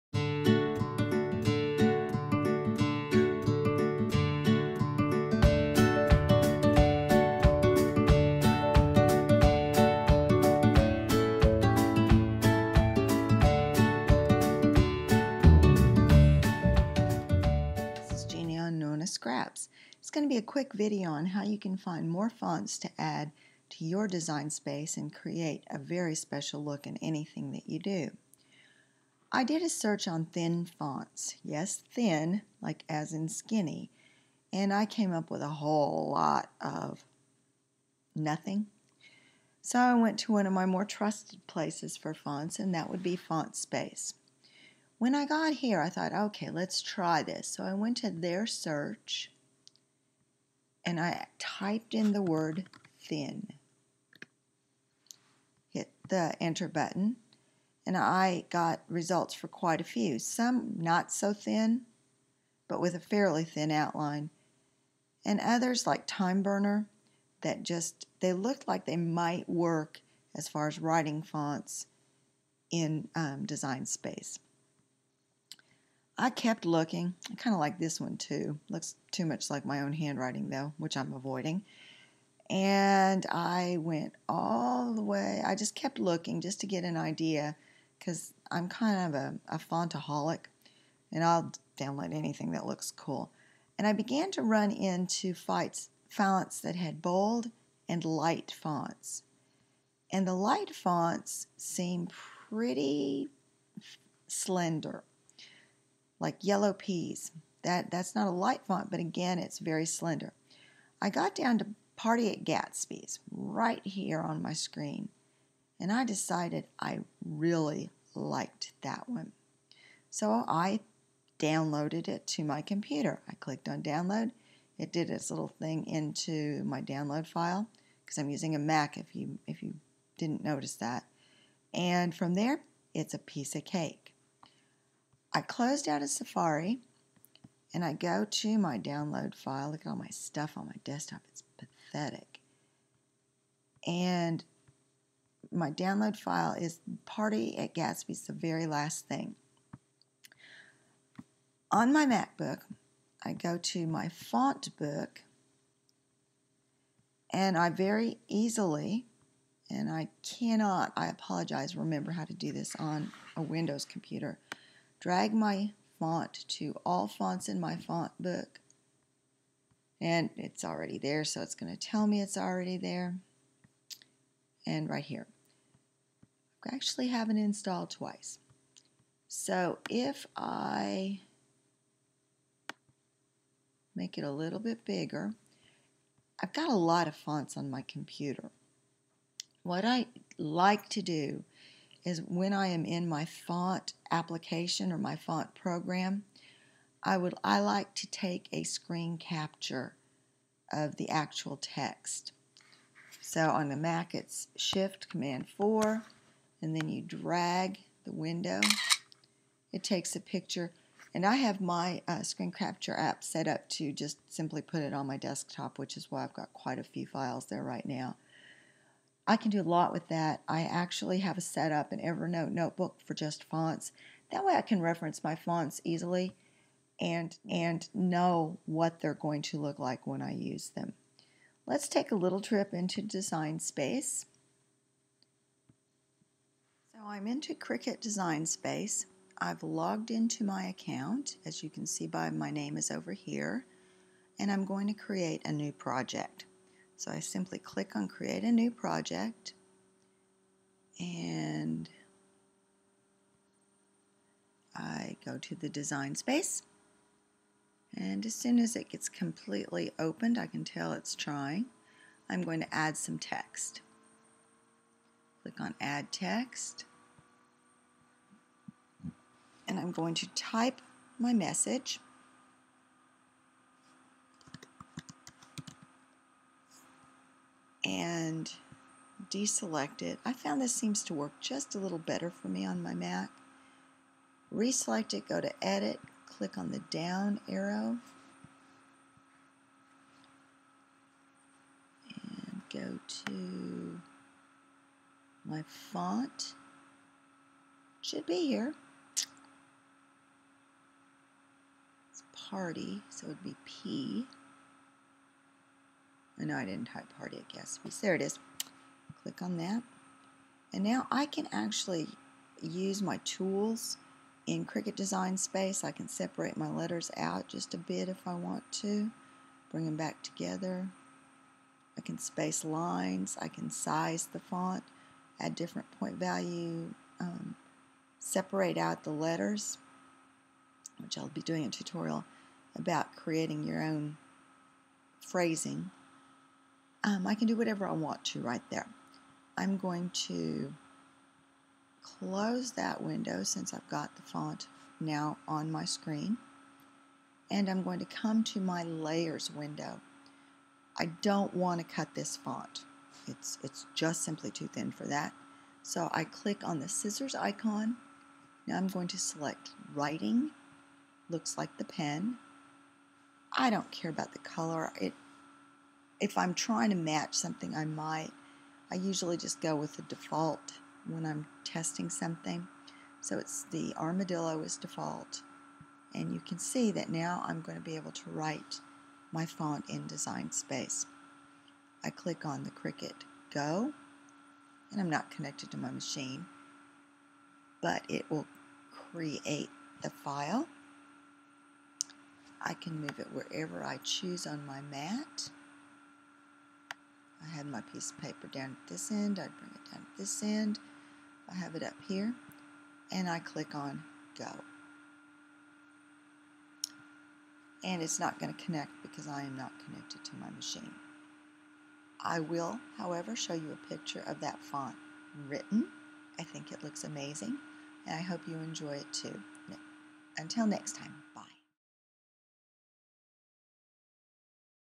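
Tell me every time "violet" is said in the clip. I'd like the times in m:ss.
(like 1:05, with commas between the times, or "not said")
not said.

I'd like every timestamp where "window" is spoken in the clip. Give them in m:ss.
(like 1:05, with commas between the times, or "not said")
2:43, 3:28, 5:43, 5:49.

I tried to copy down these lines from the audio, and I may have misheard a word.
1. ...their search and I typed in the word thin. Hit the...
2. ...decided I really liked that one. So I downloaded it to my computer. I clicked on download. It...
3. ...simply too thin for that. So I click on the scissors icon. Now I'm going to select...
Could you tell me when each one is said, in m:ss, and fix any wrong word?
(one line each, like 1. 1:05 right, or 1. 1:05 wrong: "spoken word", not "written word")
1. 0:48 right
2. 1:56 right
3. 5:54 right.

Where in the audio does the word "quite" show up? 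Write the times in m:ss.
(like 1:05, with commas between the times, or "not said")
0:59, 3:36.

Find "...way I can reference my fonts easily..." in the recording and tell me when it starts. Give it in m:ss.
3:44.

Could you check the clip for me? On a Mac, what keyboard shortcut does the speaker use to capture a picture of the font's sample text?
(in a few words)
Shift Command 4.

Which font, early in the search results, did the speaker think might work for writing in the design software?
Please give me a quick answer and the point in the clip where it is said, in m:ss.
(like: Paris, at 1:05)
Time Burner, at 1:06.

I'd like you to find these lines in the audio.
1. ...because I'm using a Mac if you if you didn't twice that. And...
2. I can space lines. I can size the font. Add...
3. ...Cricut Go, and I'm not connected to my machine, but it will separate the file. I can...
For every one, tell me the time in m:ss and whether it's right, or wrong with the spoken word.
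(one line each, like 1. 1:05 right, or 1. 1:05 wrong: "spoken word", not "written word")
1. 2:08 wrong: "notice", not "twice"
2. 5:21 right
3. 6:22 wrong: "create", not "separate".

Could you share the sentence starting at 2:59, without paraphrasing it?
So if I make it a little bit bigger, I've got a lot of fonts on my computer.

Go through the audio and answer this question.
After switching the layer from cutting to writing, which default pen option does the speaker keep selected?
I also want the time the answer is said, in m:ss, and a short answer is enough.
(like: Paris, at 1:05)
armadillo, at 6:13.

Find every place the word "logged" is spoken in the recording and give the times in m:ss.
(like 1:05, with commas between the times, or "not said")
3:59.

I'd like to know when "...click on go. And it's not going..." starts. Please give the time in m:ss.
6:43.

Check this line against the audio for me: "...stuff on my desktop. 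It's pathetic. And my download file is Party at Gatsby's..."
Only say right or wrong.
right.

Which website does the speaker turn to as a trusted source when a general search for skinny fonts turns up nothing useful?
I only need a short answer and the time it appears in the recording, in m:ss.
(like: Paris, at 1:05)
FontSpace, at 0:43.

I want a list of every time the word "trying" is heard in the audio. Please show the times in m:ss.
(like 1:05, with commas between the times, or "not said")
4:21, 6:06.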